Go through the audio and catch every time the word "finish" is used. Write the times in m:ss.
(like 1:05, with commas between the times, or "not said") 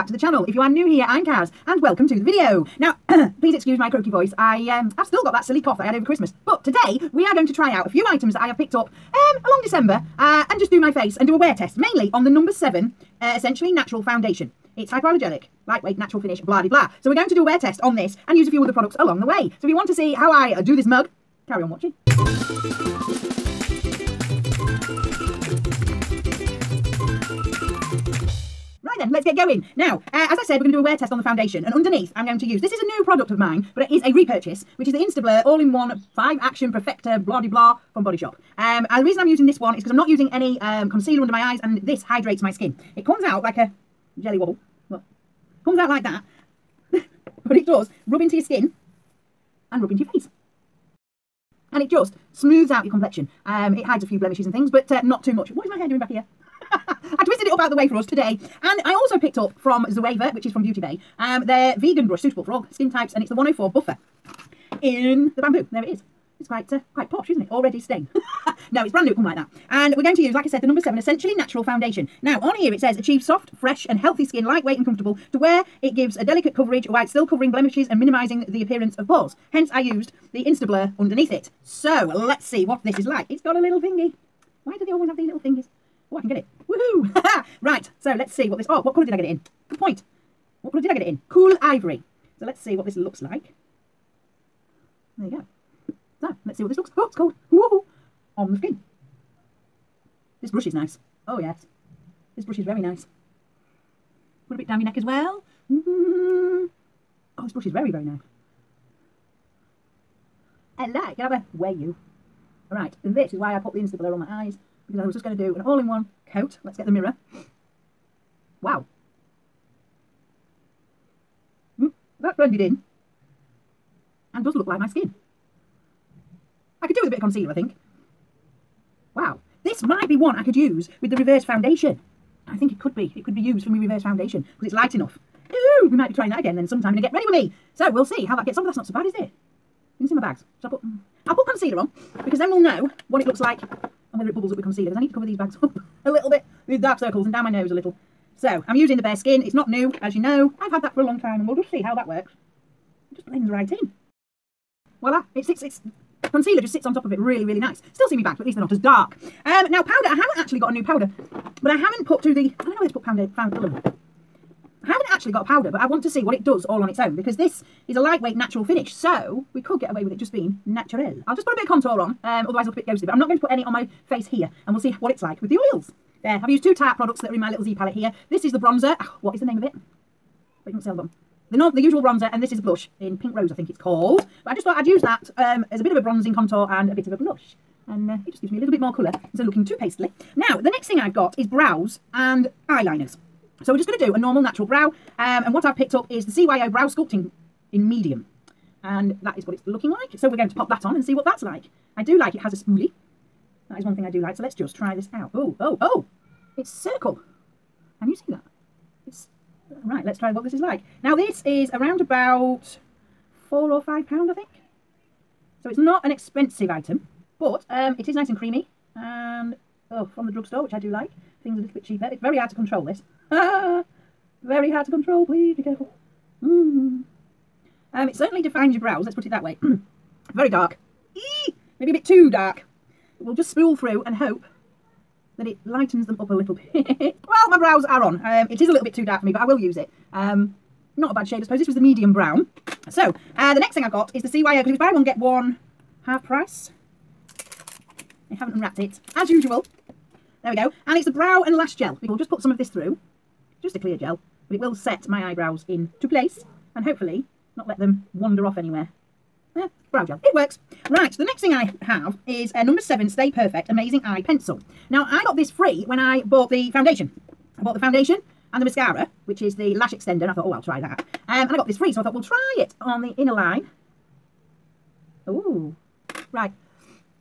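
0:16, 2:48.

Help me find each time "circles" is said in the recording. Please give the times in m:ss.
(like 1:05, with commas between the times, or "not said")
2:26, 3:26.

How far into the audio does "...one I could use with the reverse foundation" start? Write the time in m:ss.
2:10.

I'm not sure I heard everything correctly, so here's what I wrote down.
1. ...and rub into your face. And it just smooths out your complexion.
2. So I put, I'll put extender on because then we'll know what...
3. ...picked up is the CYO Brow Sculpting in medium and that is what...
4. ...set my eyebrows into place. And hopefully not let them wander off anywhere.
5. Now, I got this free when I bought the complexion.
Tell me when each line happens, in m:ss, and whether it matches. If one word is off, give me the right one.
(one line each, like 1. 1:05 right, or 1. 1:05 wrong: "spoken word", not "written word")
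1. 0:49 right
2. 2:20 wrong: "concealer", not "extender"
3. 3:15 right
4. 4:14 right
5. 4:24 wrong: "foundation", not "complexion".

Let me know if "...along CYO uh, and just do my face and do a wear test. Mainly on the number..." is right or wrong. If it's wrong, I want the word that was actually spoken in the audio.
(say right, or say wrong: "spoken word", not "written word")
wrong: "December", not "CYO".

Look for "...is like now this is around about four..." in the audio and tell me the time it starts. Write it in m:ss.
3:30.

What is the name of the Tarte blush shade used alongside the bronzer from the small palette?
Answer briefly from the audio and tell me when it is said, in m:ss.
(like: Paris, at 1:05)
Pink Rose, at 3:03.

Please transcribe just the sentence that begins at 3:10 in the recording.
Now, the next thing I've got is brows and eyeliners.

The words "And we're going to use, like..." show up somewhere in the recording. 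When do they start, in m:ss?
1:09.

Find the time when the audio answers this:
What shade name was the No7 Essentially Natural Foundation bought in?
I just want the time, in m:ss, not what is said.
1:31.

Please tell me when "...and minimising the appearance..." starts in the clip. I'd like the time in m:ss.
1:17.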